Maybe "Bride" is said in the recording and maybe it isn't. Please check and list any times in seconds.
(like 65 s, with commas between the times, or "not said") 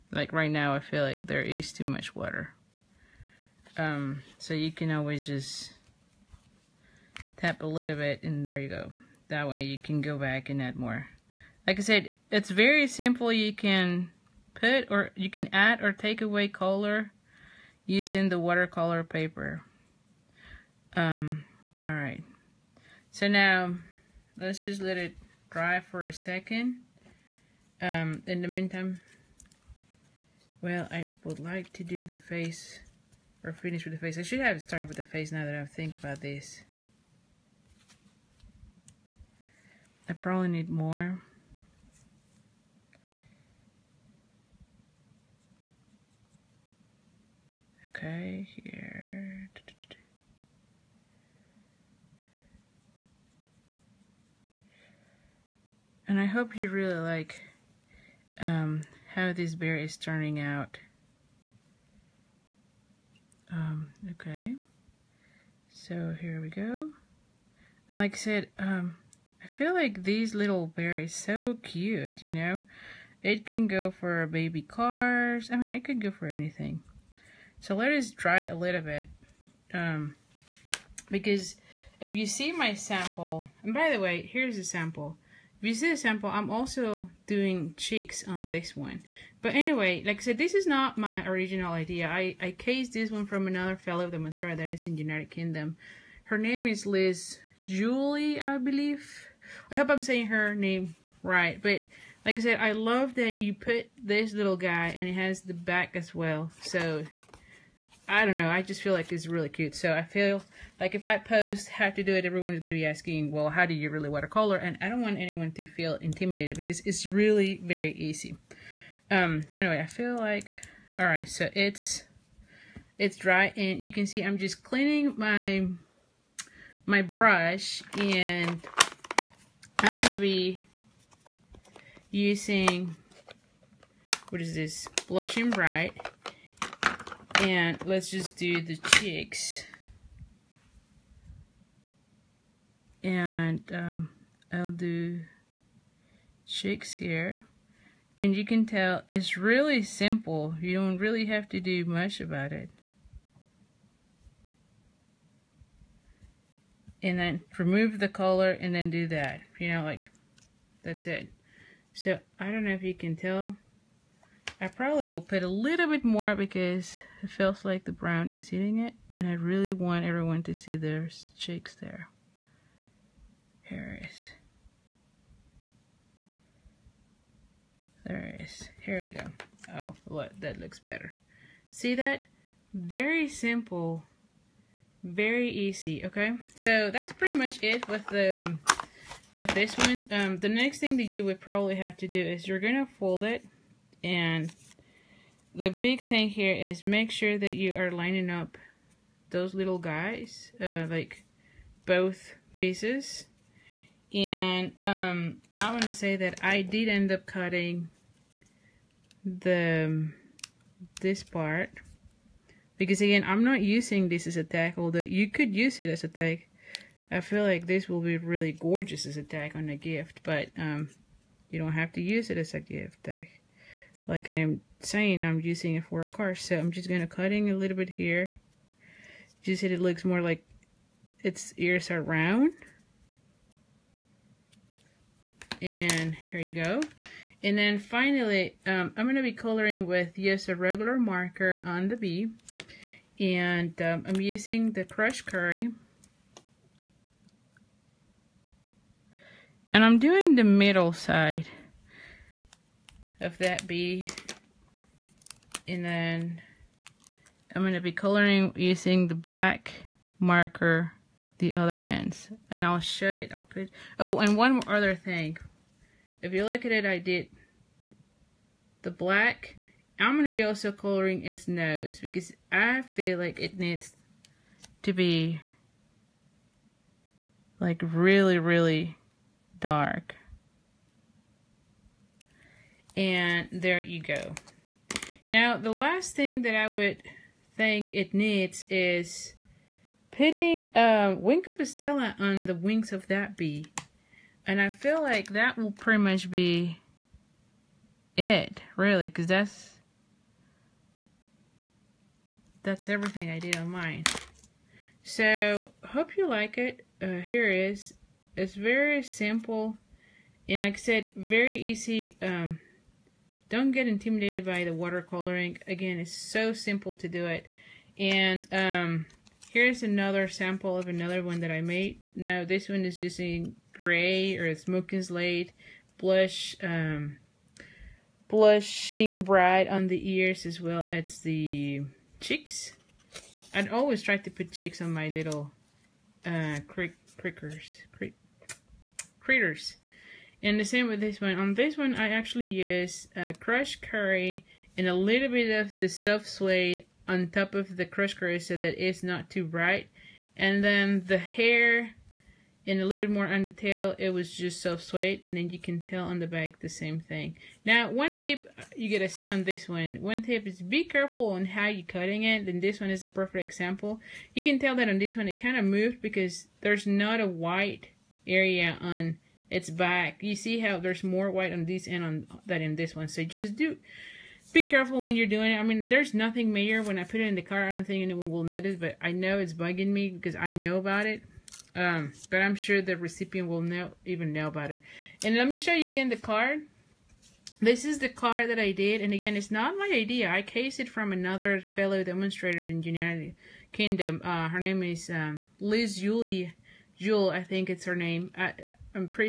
135 s, 329 s.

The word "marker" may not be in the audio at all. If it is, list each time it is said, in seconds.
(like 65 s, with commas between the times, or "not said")
240 s, 260 s.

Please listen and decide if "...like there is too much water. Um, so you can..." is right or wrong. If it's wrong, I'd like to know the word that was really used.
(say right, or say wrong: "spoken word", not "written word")
right.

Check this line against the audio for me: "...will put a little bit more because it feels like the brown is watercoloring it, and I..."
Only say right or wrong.
wrong.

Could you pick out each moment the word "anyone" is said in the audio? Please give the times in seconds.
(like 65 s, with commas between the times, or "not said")
115 s, 378 s.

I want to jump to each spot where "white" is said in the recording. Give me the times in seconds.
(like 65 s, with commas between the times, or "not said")
367 s, 371 s.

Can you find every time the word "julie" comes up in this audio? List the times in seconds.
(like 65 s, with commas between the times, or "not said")
97 s, 395 s.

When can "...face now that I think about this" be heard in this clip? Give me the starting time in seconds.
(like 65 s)
35 s.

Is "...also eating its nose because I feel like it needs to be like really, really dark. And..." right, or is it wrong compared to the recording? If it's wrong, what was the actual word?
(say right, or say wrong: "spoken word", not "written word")
wrong: "coloring", not "eating".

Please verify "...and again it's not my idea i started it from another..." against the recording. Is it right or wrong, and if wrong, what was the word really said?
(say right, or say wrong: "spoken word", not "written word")
wrong: "cased", not "started".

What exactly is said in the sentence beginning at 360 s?
One tip is be careful on how you're cutting it.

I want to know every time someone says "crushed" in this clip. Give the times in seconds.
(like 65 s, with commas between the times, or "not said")
244 s, 343 s, 347 s.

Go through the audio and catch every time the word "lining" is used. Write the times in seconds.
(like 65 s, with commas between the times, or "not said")
197 s.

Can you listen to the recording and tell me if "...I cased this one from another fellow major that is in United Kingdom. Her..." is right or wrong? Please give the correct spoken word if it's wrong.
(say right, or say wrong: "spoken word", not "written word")
wrong: "demonstrator", not "major".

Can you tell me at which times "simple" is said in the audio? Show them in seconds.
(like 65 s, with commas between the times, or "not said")
12 s, 149 s, 183 s, 309 s, 316 s.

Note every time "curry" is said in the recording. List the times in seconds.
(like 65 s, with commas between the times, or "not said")
245 s, 343 s, 348 s.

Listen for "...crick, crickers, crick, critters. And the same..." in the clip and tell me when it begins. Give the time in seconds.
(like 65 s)
336 s.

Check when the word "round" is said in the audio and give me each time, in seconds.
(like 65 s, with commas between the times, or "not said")
232 s.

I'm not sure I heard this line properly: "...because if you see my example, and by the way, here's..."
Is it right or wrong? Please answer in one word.
wrong.